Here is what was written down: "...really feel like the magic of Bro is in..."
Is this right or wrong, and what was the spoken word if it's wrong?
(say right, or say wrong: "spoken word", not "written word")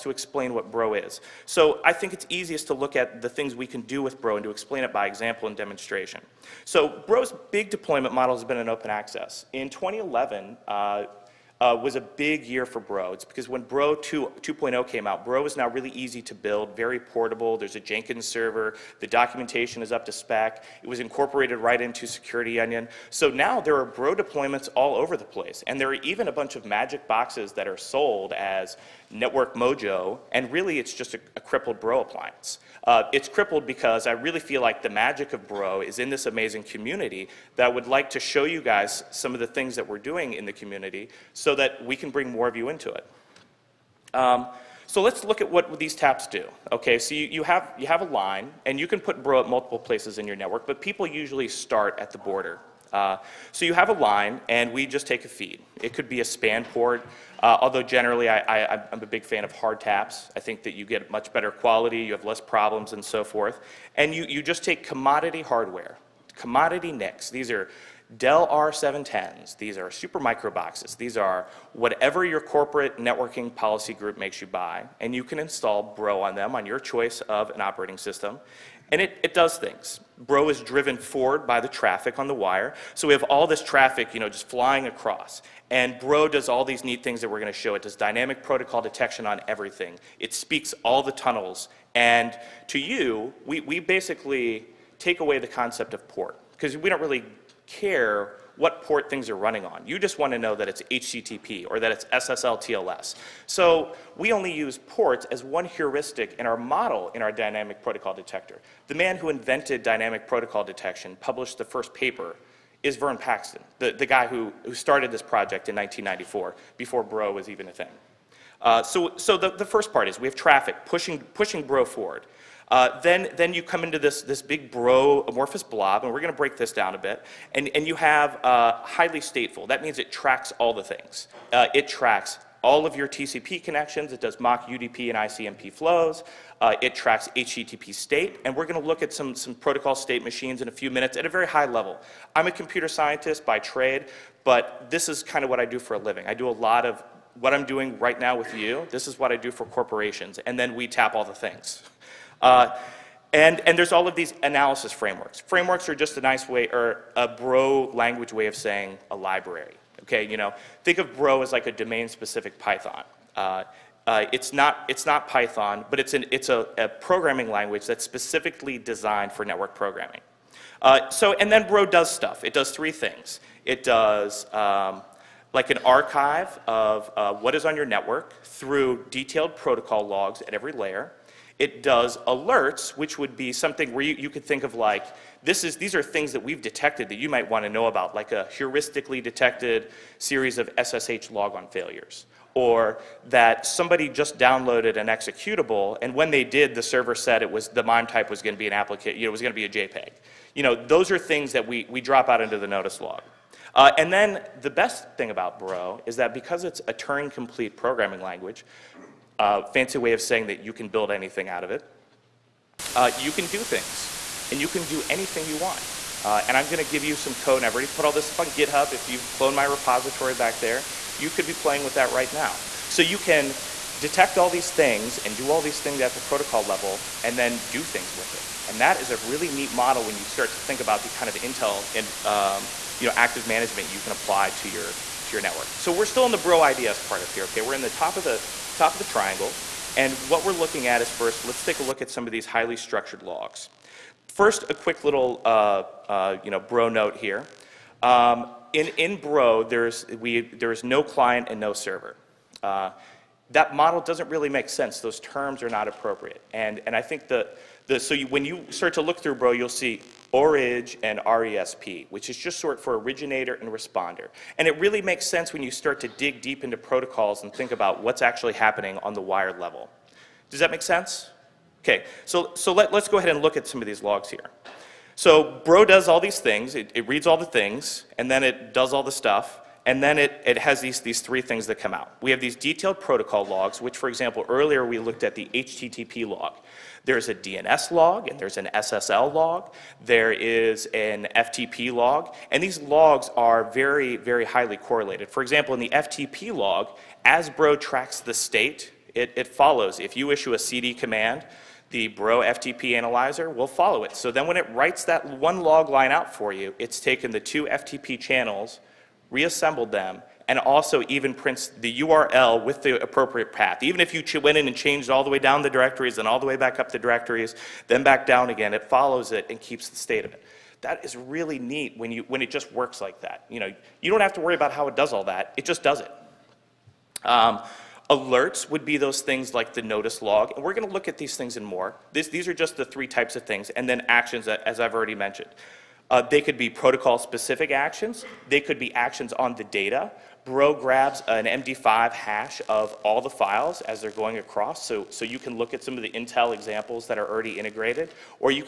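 right.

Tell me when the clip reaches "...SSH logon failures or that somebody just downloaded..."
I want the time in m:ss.
3:10.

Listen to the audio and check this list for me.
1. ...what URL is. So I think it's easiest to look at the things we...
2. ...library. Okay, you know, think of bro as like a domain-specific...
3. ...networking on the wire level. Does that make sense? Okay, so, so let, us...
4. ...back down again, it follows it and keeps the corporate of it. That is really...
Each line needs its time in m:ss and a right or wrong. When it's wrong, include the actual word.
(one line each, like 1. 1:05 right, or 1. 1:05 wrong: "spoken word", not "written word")
1. 0:00 wrong: "Bro", not "URL"
2. 2:39 right
3. 4:28 wrong: "happening", not "networking"
4. 5:18 wrong: "state", not "corporate".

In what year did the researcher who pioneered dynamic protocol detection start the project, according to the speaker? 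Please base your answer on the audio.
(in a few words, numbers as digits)
1994.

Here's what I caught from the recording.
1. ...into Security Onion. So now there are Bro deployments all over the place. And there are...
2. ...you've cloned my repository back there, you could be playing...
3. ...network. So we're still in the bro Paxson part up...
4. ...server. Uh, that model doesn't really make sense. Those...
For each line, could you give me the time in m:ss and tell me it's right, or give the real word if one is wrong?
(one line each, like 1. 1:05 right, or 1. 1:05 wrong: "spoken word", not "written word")
1. 0:21 right
2. 3:39 right
3. 3:55 wrong: "IDS", not "Paxson"
4. 4:11 right.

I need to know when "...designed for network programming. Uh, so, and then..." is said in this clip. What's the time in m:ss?
2:48.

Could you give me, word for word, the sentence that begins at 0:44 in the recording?
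Um, so let's look at what these taps do.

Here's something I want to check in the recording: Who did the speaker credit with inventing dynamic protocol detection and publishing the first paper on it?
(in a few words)
Vern Paxson.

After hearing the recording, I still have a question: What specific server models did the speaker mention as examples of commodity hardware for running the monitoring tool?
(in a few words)
Dell R710s.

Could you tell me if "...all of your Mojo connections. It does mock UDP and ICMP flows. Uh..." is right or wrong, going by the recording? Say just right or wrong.
wrong.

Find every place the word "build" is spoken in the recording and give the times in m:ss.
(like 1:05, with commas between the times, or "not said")
0:16, 3:30.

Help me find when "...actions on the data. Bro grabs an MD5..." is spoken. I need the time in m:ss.
5:38.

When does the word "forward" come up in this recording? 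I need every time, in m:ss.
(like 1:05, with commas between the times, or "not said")
1:20, 2:01.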